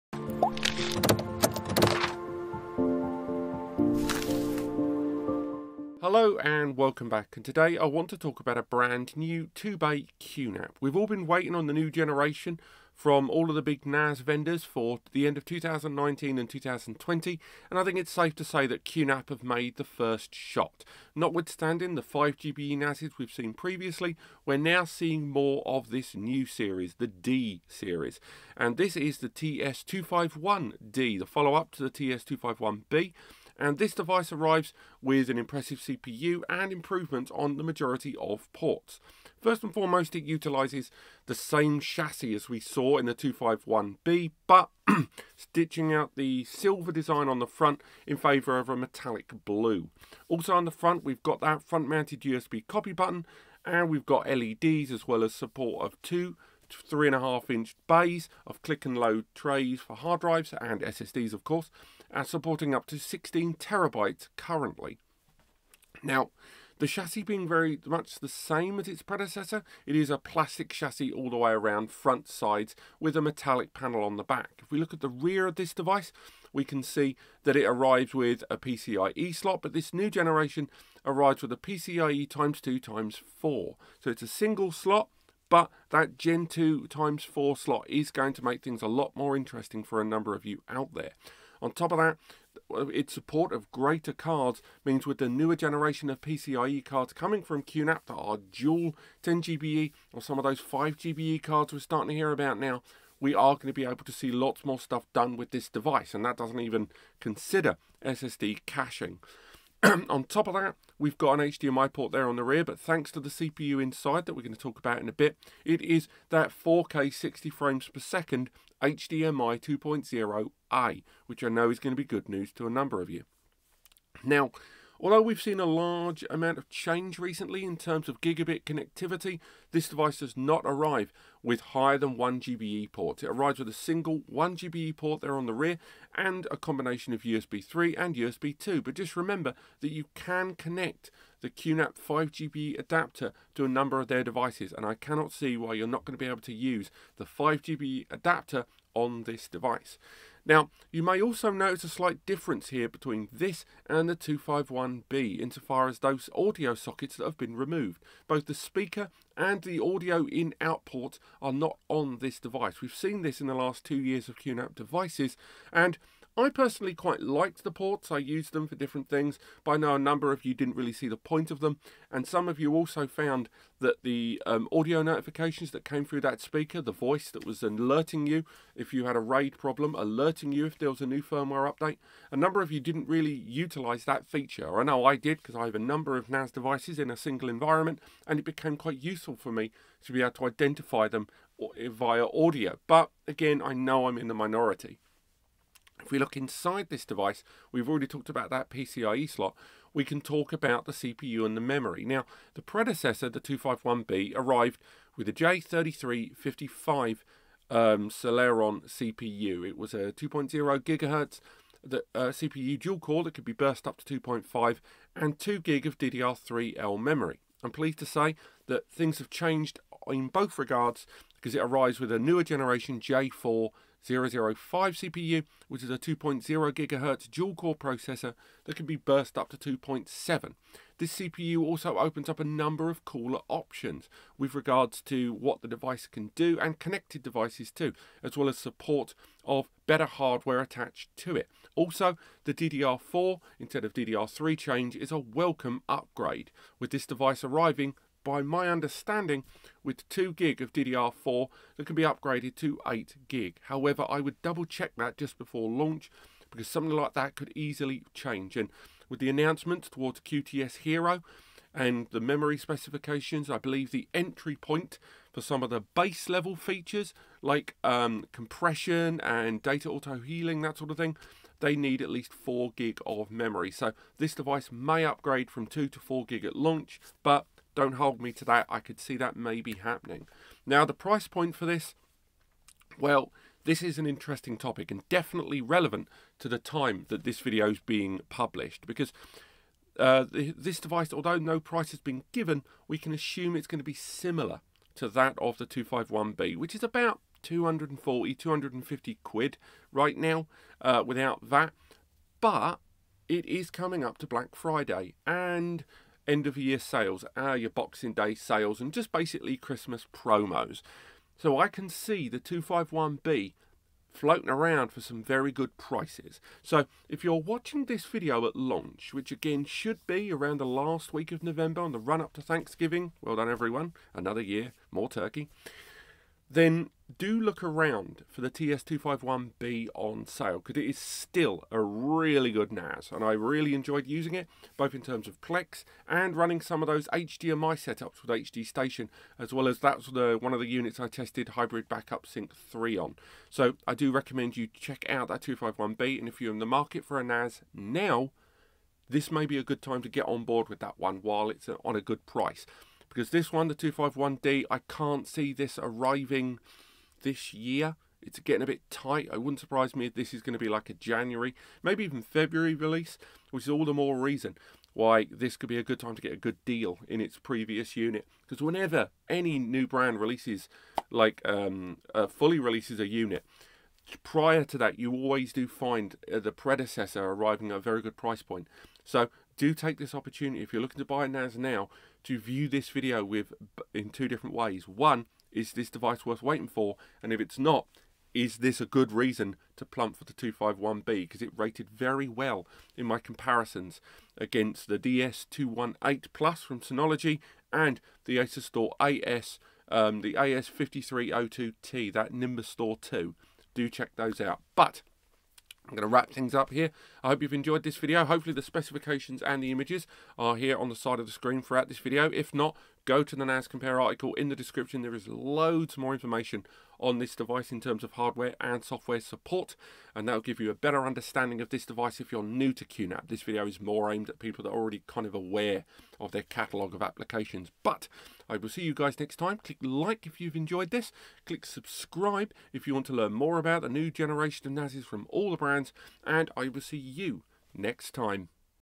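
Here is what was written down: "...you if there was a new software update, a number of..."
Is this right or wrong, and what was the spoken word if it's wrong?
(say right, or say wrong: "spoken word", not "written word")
wrong: "firmware", not "software".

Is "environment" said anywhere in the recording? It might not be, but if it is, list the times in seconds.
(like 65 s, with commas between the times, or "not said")
187 s.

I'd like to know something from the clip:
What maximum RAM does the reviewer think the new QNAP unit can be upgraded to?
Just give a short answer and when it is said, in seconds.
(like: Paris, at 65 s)
8 gig, at 252 s.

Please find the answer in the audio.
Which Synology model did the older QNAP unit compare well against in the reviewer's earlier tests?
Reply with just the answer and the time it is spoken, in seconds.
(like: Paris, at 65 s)
DS218 Plus, at 394 s.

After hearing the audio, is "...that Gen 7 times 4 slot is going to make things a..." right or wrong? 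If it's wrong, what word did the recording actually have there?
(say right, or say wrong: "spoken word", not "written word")
wrong: "2", not "7".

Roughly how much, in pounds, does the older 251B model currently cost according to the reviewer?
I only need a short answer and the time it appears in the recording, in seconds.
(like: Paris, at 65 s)
240-250 pounds, at 297 s.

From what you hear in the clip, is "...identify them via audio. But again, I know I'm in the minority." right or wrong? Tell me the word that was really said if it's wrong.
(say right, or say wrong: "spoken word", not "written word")
right.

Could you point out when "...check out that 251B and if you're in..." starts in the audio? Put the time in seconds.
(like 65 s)
344 s.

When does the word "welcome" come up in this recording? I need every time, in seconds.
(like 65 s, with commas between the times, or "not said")
6 s, 245 s.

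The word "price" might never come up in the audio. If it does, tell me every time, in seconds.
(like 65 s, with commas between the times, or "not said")
280 s, 291 s, 315 s, 352 s, 378 s.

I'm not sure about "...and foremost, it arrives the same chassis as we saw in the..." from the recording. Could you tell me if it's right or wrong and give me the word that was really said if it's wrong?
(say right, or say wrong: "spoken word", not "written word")
wrong: "utilises", not "arrives".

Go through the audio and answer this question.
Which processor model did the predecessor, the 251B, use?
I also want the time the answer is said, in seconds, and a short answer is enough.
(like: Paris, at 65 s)
J3355, at 205 s.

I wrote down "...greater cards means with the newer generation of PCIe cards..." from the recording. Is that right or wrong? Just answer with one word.
right.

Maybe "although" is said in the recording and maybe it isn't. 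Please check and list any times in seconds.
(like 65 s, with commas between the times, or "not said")
125 s, 291 s.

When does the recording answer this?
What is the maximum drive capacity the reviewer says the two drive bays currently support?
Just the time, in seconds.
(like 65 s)
62 s.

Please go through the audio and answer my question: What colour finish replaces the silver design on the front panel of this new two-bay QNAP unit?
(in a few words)
metallic blue.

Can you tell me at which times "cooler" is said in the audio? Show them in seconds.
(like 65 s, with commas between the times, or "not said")
233 s.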